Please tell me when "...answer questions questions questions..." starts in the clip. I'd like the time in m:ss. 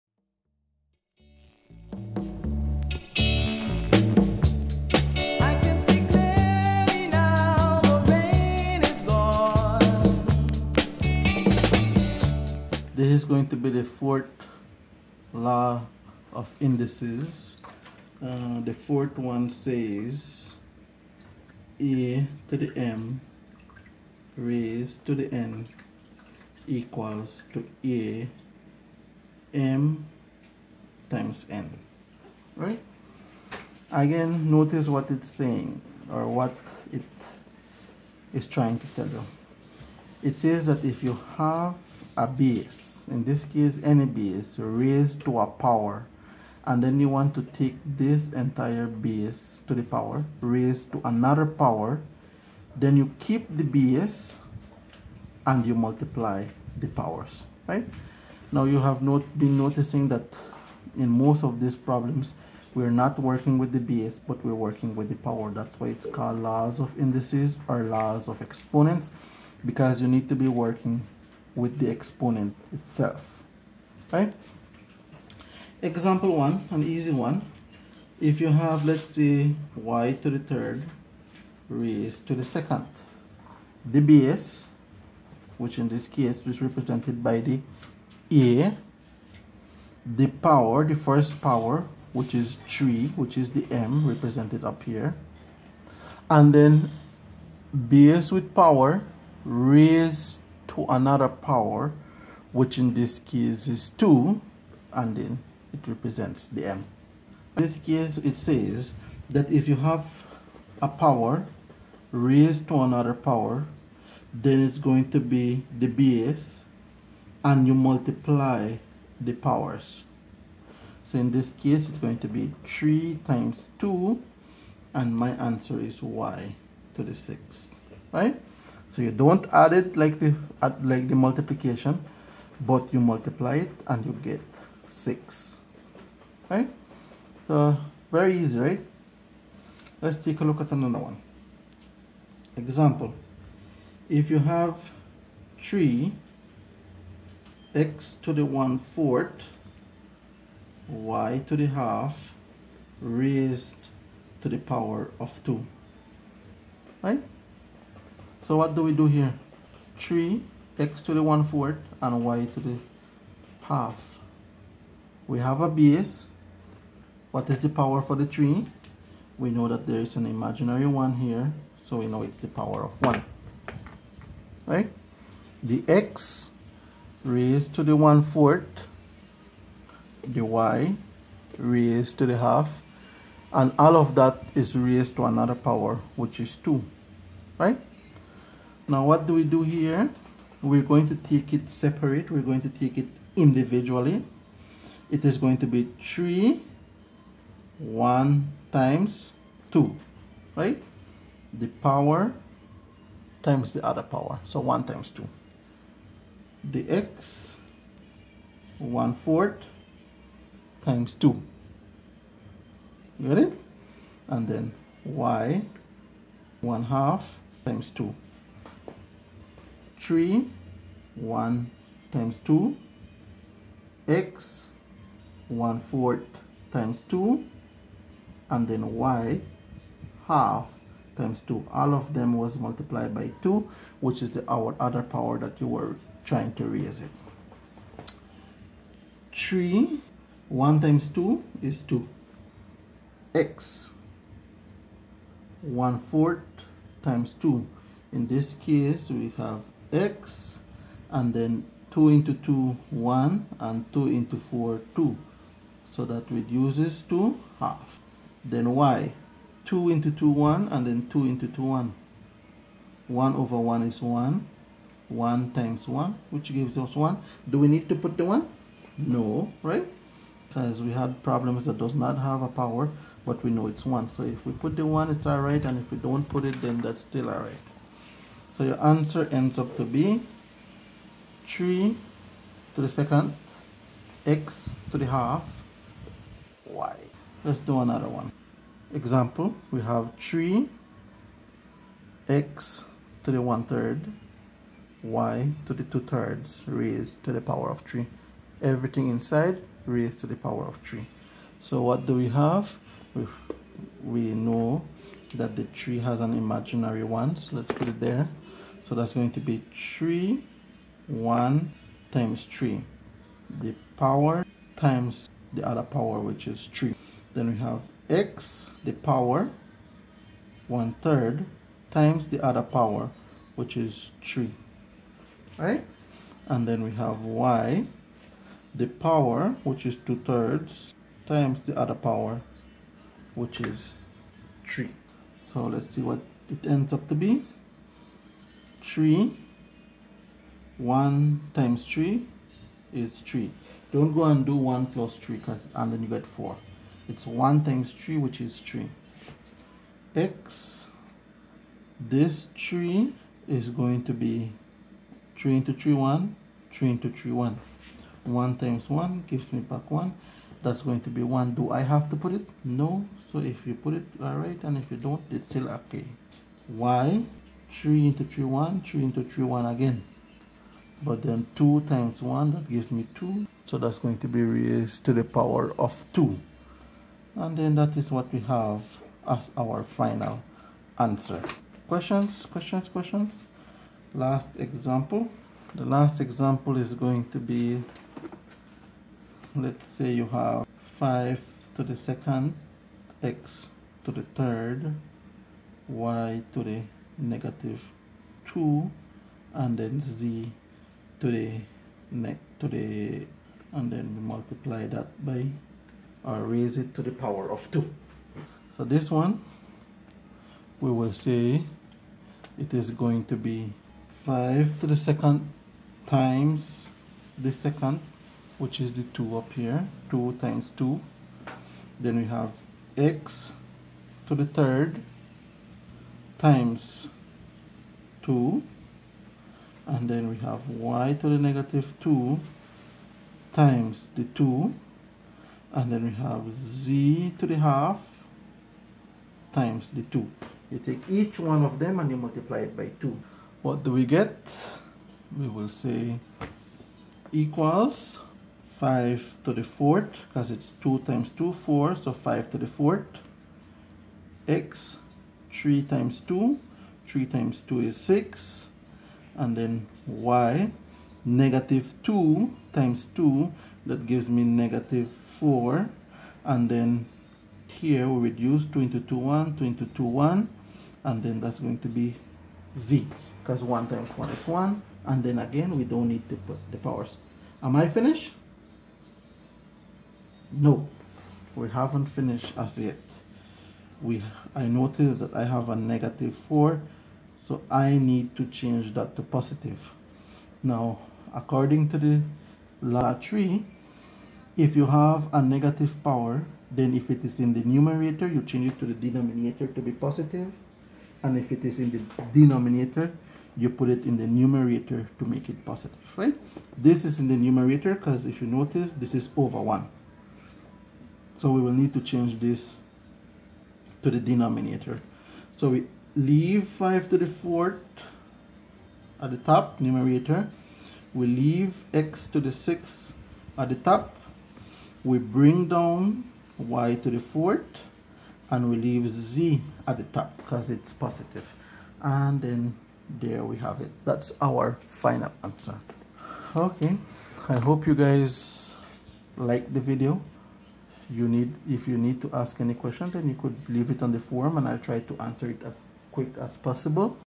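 6:20.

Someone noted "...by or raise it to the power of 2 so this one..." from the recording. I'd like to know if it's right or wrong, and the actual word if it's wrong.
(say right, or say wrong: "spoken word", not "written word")
right.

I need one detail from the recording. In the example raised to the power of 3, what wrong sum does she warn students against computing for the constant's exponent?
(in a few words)
4.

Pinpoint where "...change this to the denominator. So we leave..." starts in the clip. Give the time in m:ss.
8:32.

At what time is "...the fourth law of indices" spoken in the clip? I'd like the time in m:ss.
0:13.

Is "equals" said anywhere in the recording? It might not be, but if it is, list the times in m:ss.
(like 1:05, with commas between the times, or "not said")
0:26, 7:27.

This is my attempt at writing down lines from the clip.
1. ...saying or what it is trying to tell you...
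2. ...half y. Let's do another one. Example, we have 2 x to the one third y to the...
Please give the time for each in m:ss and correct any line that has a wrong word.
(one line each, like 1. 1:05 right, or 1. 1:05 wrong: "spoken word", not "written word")
1. 0:35 right
2. 4:45 wrong: "3", not "2".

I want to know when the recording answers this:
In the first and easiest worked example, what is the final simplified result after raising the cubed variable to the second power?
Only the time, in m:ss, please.
2:06.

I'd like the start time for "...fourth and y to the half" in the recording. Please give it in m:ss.
2:41.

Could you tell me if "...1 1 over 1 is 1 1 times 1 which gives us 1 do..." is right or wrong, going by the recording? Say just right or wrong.
right.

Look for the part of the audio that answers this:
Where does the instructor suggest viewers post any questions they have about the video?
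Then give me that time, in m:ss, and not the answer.
9:04.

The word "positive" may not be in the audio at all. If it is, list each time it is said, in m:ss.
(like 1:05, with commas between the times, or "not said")
8:09, 8:19, 8:25, 8:50.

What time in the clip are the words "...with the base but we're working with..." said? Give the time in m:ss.
1:03.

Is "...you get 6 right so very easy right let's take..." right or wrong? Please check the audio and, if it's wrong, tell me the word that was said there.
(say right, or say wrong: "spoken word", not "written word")
right.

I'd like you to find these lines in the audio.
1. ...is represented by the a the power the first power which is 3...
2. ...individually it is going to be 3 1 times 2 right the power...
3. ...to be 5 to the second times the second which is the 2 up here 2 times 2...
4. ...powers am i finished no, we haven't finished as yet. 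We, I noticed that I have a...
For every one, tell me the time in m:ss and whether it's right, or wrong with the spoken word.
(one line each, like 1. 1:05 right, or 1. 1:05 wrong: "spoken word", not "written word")
1. 1:26 right
2. 3:13 right
3. 6:53 right
4. 7:56 right.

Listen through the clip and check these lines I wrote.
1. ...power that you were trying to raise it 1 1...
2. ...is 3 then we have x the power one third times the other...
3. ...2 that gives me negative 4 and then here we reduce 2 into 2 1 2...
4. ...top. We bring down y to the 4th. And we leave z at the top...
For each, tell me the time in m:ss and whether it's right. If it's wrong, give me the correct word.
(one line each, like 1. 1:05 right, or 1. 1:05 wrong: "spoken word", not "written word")
1. 3:55 wrong: "3", not "1"
2. 5:16 right
3. 7:43 right
4. 8:43 right.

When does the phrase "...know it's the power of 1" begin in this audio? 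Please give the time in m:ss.
2:52.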